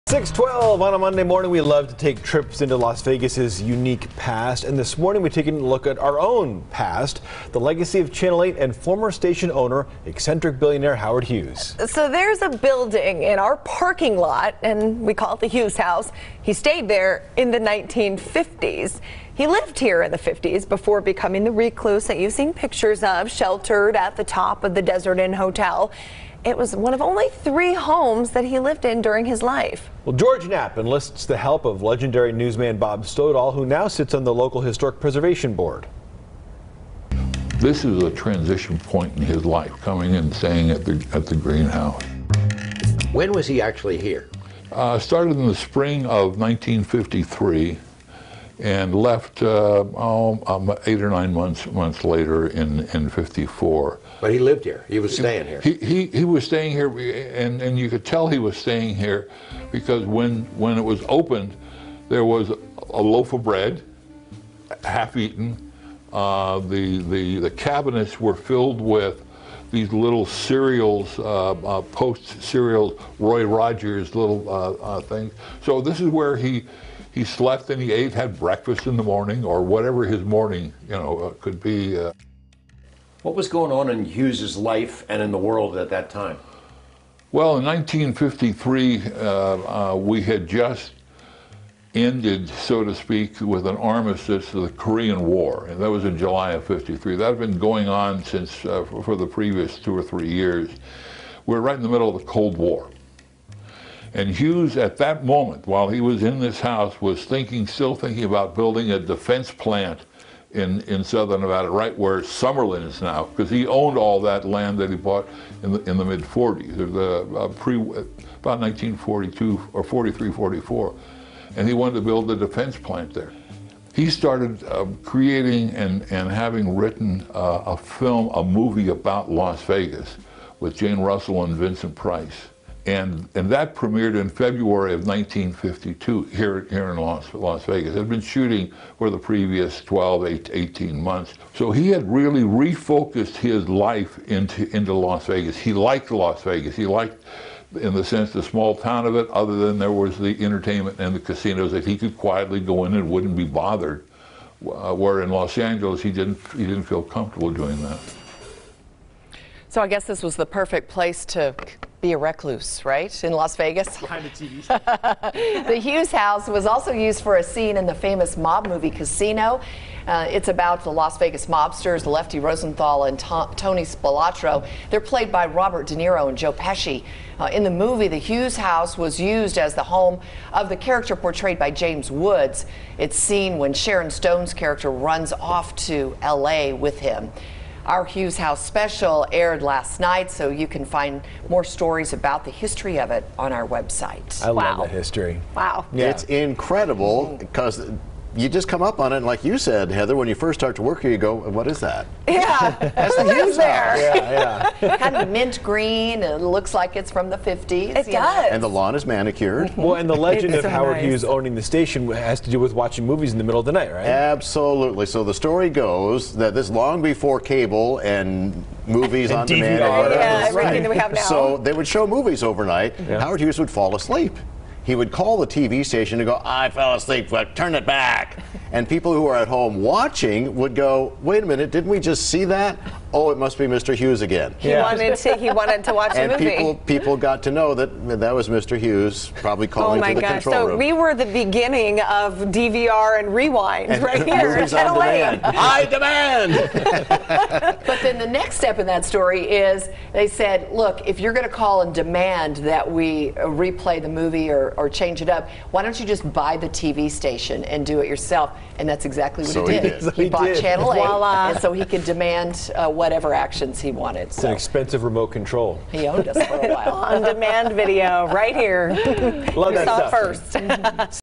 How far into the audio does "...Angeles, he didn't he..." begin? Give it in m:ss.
2:35.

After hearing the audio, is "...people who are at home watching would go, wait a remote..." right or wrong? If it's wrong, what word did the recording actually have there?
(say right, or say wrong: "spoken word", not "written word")
wrong: "minute", not "remote".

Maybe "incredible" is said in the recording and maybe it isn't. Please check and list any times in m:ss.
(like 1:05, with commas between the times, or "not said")
3:16.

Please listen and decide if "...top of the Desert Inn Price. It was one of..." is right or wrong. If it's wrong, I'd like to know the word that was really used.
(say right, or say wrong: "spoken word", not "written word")
wrong: "Hotel", not "Price".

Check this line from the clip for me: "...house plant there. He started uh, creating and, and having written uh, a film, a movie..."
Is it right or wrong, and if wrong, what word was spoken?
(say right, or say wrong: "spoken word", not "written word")
wrong: "defense", not "house".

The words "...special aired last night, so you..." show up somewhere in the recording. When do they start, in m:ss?
3:08.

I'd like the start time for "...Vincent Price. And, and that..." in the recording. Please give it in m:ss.
2:11.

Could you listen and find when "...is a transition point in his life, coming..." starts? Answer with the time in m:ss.
0:37.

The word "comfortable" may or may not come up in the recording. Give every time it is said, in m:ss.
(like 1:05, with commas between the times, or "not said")
2:37.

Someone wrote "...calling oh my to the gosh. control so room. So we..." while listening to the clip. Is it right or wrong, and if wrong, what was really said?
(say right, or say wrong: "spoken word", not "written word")
right.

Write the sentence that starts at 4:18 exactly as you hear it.
And that's exactly what so he did.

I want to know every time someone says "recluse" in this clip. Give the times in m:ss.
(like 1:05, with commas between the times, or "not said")
0:21, 2:42.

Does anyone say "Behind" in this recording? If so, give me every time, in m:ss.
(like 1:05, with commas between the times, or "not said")
2:43.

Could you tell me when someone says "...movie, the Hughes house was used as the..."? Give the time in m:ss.
2:57.